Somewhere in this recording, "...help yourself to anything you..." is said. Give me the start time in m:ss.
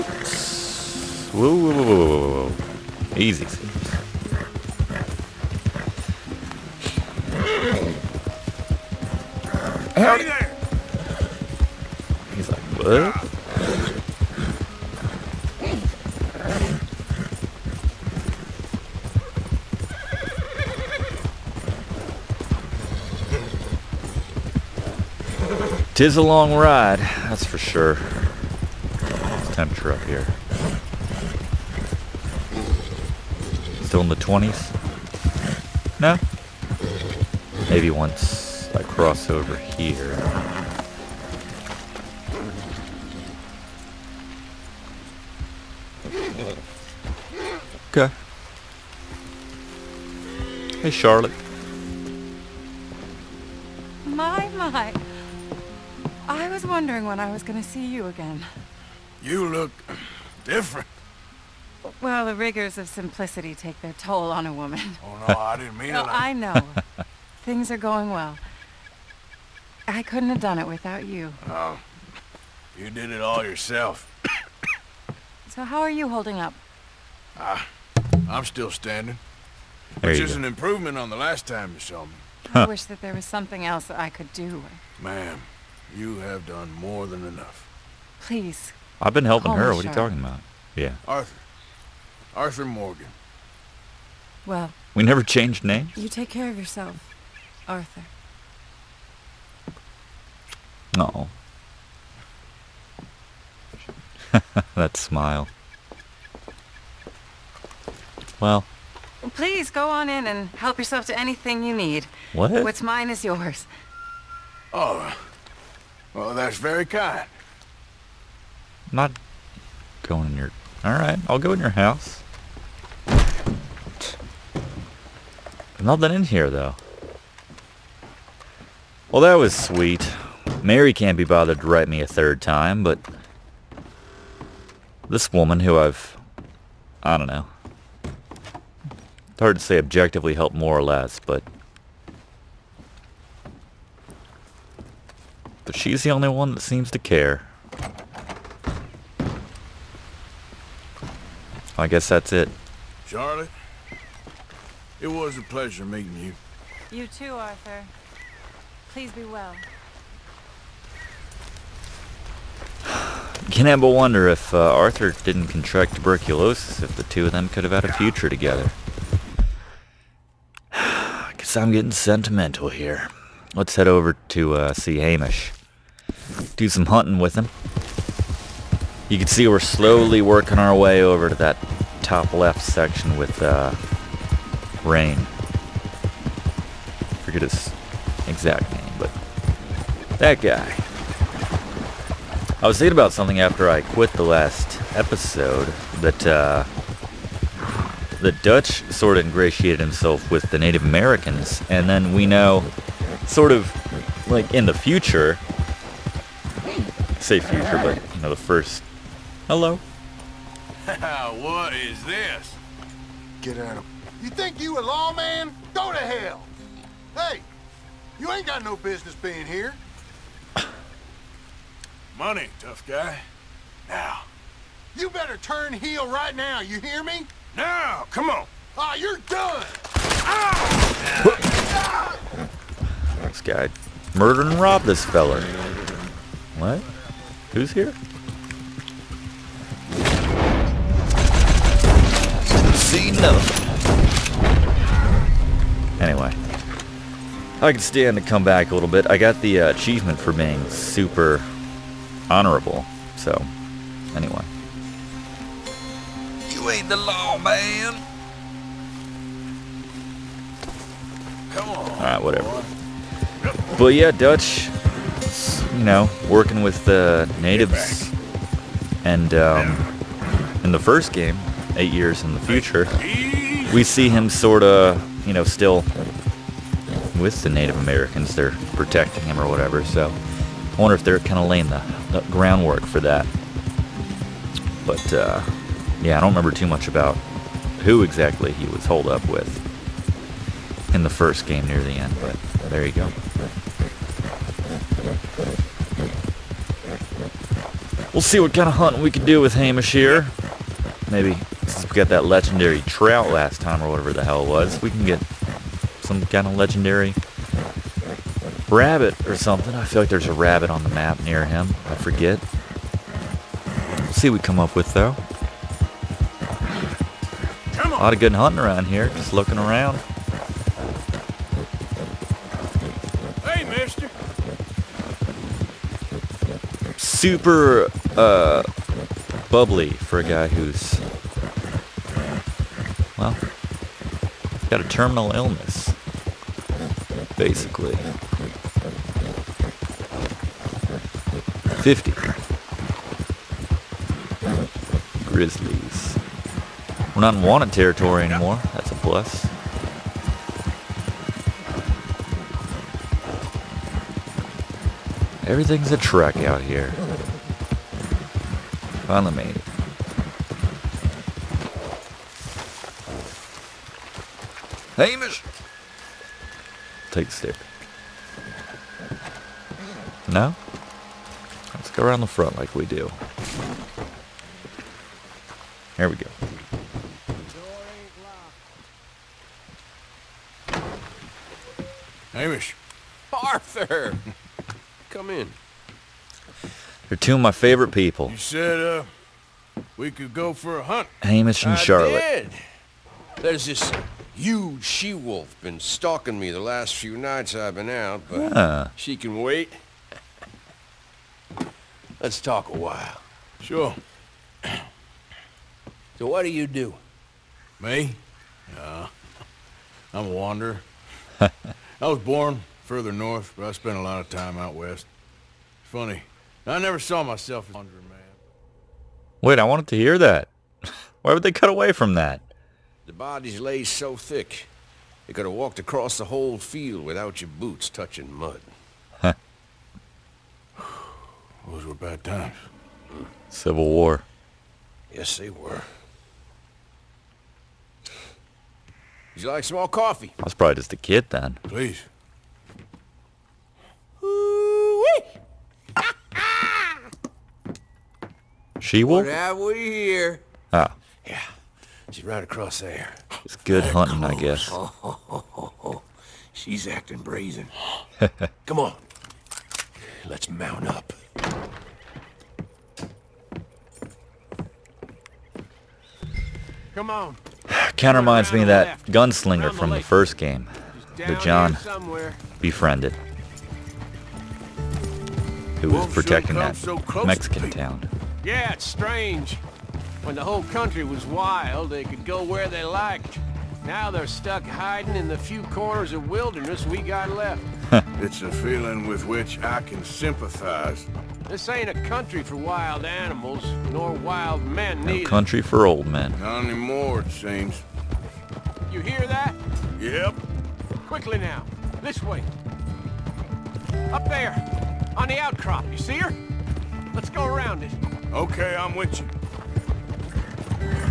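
1:50.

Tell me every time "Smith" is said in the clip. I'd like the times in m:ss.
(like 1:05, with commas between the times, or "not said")
not said.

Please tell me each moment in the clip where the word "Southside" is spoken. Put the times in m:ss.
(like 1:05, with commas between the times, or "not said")
not said.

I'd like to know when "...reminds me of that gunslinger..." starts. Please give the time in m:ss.
7:48.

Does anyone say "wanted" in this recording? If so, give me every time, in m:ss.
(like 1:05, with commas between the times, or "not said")
5:47, 6:59.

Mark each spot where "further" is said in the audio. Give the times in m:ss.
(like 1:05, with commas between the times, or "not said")
6:52.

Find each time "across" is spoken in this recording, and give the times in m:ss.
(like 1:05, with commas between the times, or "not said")
7:05, 7:32.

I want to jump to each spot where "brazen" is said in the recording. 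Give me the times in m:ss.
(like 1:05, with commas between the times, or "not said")
7:37.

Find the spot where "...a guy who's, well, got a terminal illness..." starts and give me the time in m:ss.
5:30.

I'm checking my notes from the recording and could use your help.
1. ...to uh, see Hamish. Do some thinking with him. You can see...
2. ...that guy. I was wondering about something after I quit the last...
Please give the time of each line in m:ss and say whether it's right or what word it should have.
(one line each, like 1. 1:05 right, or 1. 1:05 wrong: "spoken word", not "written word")
1. 2:54 wrong: "hunting", not "thinking"
2. 3:10 wrong: "thinking", not "wondering".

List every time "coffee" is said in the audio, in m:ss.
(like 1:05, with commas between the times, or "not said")
7:19.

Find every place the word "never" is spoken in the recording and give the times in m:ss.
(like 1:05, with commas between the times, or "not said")
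1:35, 6:56.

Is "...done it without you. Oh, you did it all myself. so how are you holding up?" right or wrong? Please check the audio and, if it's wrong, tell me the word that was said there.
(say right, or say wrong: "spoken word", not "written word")
wrong: "yourself", not "myself".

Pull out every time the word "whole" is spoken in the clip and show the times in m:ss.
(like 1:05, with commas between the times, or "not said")
7:06, 8:00.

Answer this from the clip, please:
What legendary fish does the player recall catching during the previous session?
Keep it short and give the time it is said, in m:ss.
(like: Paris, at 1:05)
trout, at 5:02.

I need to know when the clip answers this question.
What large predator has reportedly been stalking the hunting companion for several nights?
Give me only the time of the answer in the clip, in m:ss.
6:34.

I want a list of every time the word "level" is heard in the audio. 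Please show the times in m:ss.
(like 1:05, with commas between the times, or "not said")
not said.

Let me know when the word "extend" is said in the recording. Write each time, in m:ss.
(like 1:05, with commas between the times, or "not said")
not said.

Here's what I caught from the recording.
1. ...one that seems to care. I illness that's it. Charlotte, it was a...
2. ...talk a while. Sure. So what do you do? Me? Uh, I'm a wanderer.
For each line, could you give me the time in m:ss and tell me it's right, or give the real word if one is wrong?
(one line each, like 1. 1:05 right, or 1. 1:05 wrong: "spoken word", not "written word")
1. 2:26 wrong: "guess", not "illness"
2. 6:42 right.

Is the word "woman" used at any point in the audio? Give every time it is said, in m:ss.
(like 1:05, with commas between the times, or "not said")
1:04, 2:15.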